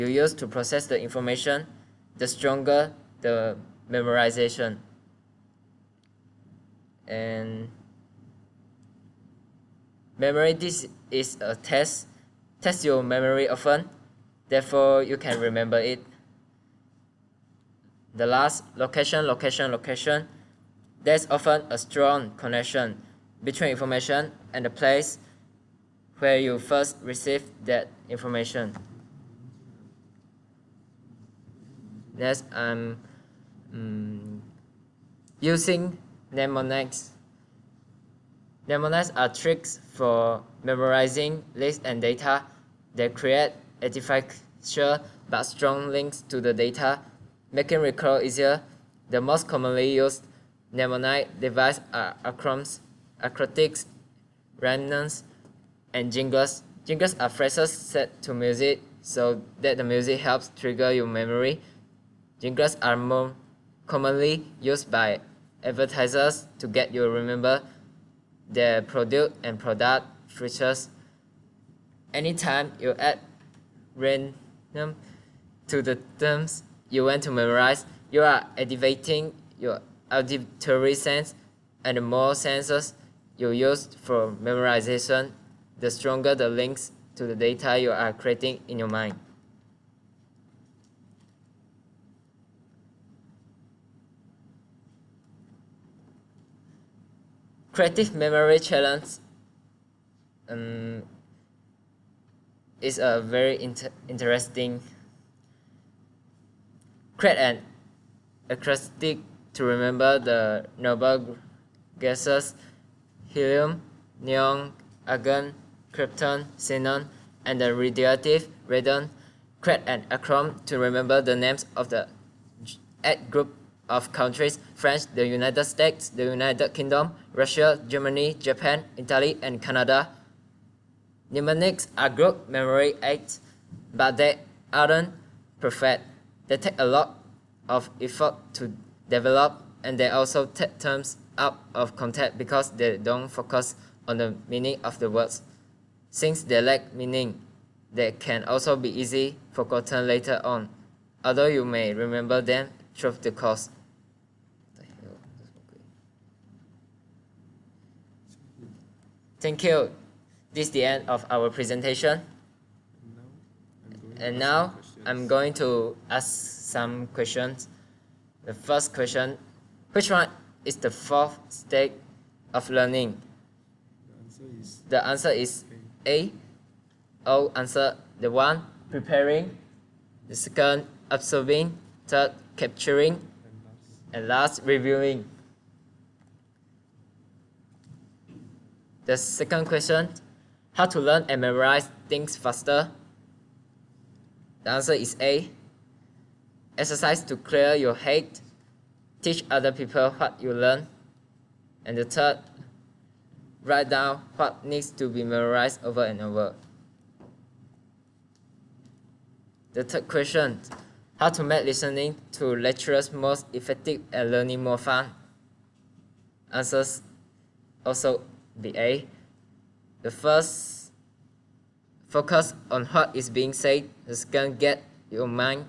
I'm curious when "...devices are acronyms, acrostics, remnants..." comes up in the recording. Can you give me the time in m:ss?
0:51.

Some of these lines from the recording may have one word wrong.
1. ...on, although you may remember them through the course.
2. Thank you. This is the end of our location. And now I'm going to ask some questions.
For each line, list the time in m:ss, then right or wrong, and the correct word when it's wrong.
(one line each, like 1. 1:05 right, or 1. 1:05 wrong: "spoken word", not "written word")
1. 2:30 right
2. 2:39 wrong: "presentation", not "location".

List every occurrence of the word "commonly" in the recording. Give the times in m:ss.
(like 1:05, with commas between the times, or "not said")
0:49, 1:03.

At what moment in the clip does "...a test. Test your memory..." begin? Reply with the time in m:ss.
0:11.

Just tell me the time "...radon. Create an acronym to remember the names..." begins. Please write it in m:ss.
1:58.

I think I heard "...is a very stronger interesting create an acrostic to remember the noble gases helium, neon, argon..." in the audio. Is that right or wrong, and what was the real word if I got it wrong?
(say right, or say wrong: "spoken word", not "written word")
wrong: "inter", not "stronger".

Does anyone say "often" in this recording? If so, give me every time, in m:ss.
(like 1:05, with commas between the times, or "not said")
0:13, 0:21.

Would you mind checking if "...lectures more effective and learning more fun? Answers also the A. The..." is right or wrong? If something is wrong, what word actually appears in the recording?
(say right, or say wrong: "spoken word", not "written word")
right.